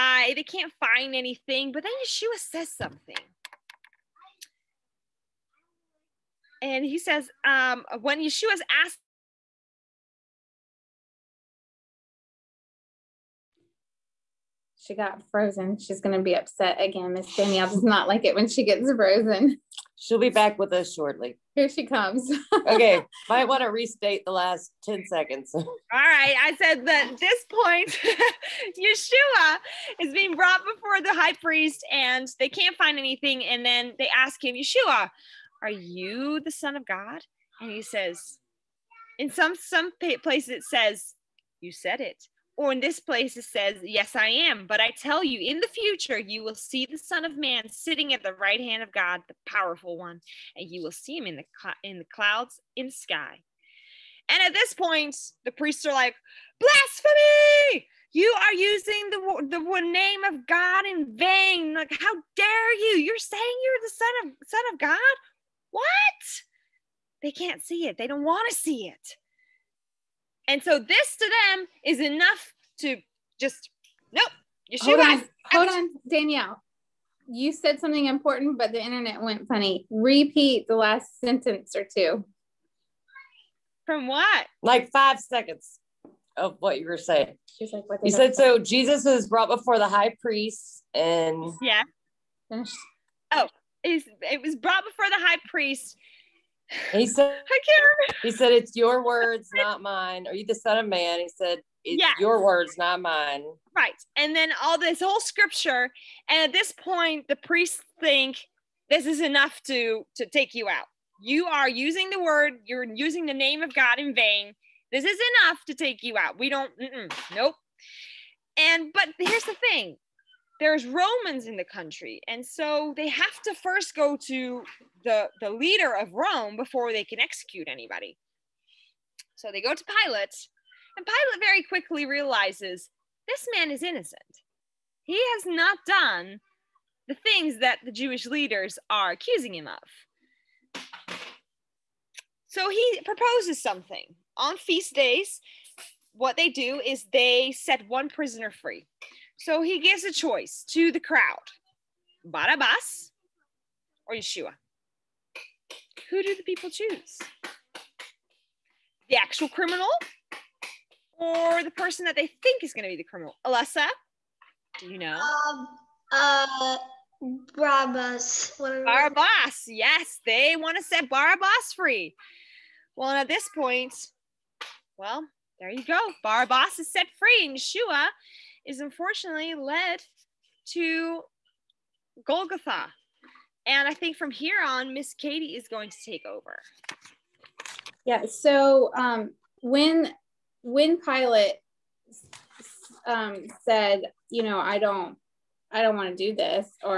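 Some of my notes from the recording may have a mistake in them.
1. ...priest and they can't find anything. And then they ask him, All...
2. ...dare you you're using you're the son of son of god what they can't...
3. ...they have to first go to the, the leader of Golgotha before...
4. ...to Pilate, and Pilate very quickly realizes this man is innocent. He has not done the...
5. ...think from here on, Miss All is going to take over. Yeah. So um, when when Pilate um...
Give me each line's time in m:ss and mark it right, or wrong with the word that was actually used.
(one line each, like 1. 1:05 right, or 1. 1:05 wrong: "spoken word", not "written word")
1. 0:31 wrong: "Yeshua", not "All"
2. 1:02 wrong: "saying", not "using"
3. 2:02 wrong: "Rome", not "Golgotha"
4. 2:09 right
5. 3:03 wrong: "Katie", not "All".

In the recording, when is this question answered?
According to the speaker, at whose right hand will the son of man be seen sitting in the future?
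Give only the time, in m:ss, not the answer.
0:48.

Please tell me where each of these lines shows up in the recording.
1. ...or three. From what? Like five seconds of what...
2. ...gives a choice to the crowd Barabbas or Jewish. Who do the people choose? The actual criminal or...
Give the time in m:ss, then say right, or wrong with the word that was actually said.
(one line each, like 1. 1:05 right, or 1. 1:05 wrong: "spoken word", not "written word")
1. 1:21 wrong: "two", not "three"
2. 2:29 wrong: "Yeshua", not "Jewish".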